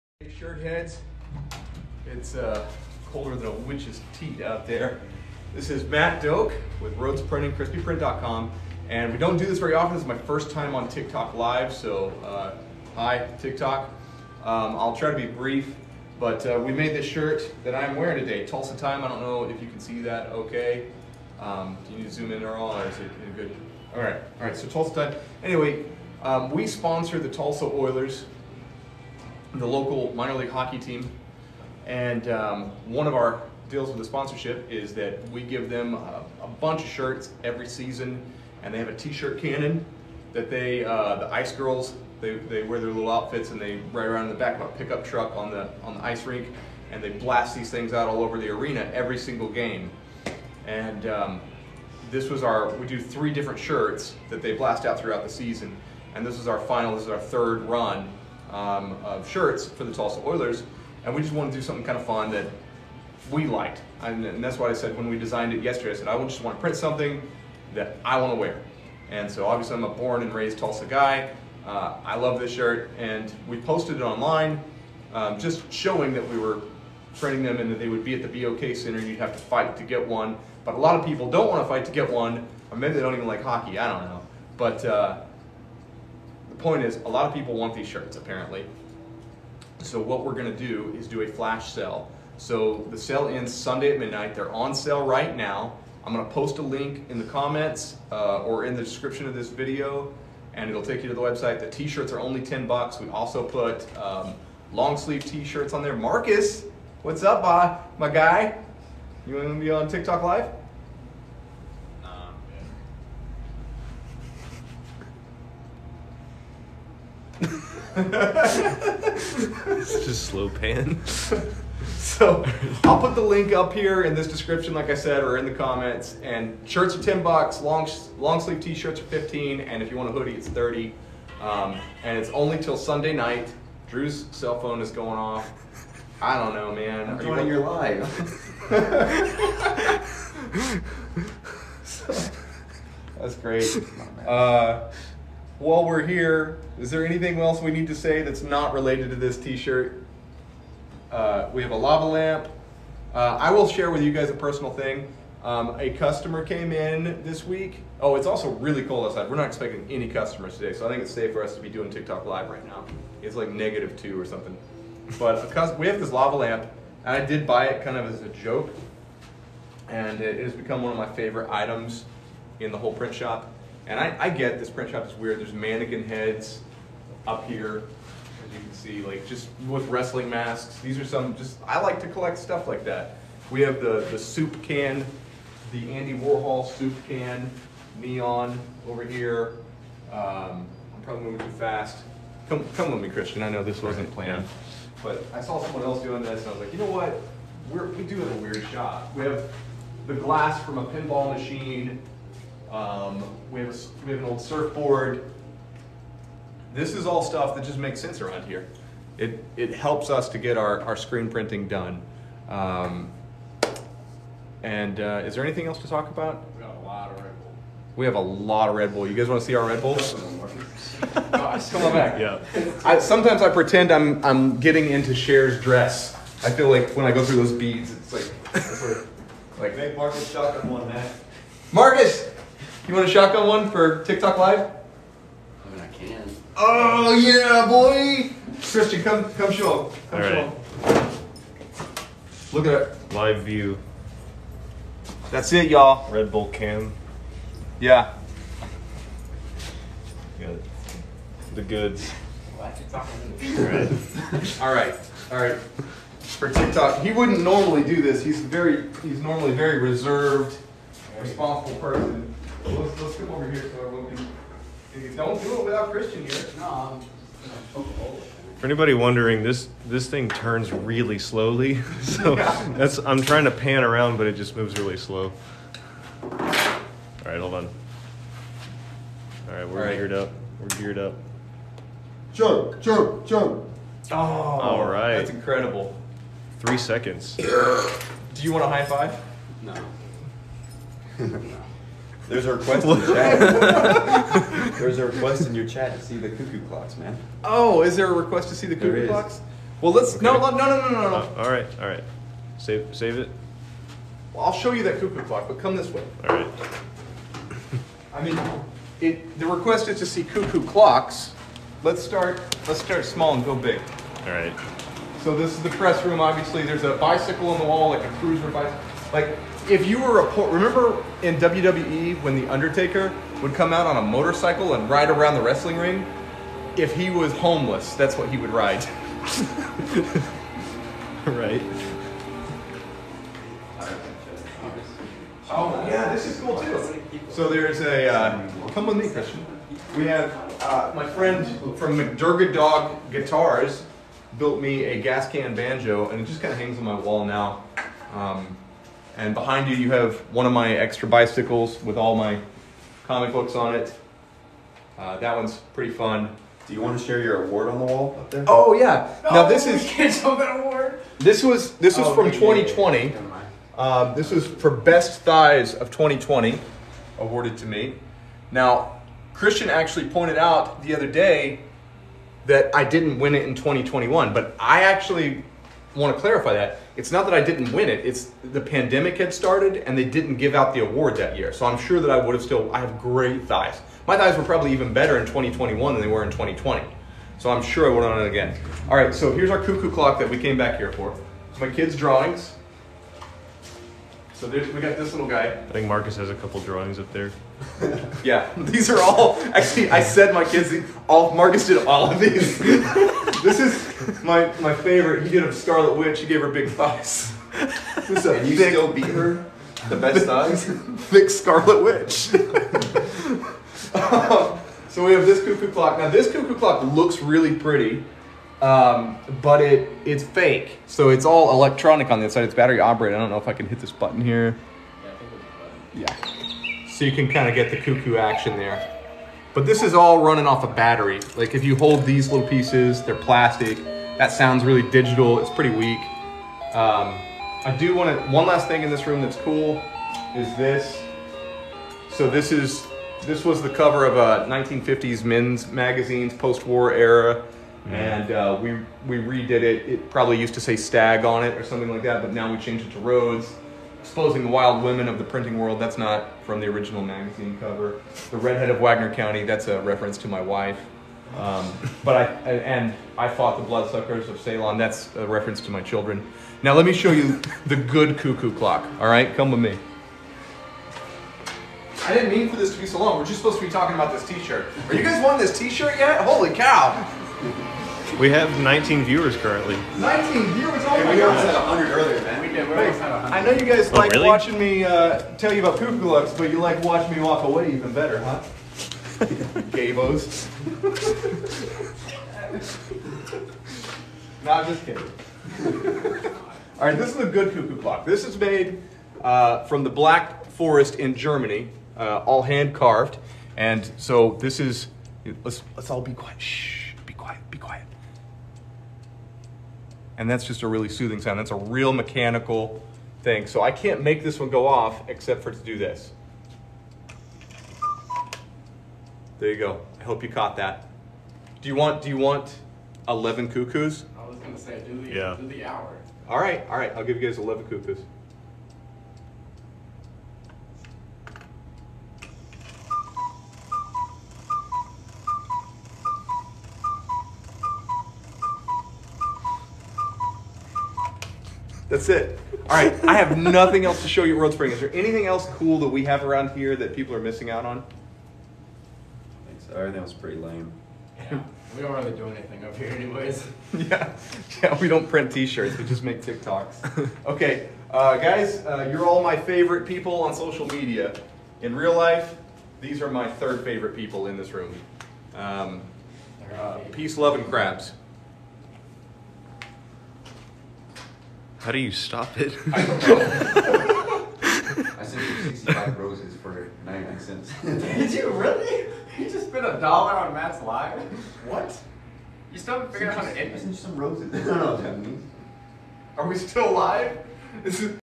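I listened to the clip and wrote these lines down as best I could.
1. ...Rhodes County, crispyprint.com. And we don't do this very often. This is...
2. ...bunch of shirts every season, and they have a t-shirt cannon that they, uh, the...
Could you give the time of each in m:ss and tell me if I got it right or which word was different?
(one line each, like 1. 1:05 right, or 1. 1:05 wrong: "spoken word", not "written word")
1. 0:06 wrong: "Printing", not "County"
2. 0:36 right.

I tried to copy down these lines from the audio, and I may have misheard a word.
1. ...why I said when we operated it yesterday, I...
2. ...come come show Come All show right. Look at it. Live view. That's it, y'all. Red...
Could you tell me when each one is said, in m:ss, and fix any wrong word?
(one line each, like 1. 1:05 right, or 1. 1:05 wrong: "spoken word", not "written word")
1. 1:04 wrong: "designed", not "operated"
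2. 3:59 right.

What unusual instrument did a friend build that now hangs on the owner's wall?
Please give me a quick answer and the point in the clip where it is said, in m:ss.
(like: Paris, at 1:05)
Gas can banjo, at 5:45.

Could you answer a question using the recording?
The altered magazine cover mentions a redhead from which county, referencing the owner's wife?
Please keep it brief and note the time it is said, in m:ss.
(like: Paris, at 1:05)
Wagoner County, at 7:38.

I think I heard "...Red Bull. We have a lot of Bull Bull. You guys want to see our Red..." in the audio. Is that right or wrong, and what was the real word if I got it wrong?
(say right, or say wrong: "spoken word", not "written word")
wrong: "Red", not "Bull".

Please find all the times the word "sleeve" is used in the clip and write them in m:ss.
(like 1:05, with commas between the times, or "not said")
1:44, 2:08.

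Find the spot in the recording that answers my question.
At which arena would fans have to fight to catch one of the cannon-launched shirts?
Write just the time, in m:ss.
1:18.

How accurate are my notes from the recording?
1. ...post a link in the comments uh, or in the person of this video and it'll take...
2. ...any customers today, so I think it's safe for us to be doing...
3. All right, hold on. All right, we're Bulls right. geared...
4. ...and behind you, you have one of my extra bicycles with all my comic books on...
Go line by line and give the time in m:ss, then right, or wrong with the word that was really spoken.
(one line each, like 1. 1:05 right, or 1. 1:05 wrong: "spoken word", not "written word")
1. 1:36 wrong: "description", not "person"
2. 2:39 right
3. 4:36 wrong: "All", not "Bulls"
4. 5:49 right.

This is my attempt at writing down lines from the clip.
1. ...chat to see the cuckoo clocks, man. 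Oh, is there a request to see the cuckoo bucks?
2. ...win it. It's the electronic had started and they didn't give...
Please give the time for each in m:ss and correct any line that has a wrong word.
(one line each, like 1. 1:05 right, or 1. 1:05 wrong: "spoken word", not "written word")
1. 4:55 wrong: "clocks", not "bucks"
2. 6:17 wrong: "pandemic", not "electronic".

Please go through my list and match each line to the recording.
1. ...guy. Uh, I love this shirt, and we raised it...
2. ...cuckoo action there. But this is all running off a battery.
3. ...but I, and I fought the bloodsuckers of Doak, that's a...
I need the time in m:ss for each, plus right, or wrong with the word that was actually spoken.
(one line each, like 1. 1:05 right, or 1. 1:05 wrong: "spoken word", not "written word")
1. 1:10 wrong: "posted", not "raised"
2. 7:07 right
3. 7:42 wrong: "Ceylon", not "Doak".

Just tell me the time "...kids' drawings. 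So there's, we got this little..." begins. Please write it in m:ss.
6:31.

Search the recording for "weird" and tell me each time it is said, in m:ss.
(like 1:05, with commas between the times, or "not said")
2:55, 3:18.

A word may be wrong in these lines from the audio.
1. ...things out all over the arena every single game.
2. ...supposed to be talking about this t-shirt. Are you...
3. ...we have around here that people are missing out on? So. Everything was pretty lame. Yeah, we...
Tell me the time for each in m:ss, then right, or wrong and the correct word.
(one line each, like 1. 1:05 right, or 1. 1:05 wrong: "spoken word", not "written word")
1. 0:47 right
2. 7:53 right
3. 9:05 right.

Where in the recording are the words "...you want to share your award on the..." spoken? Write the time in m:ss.
5:56.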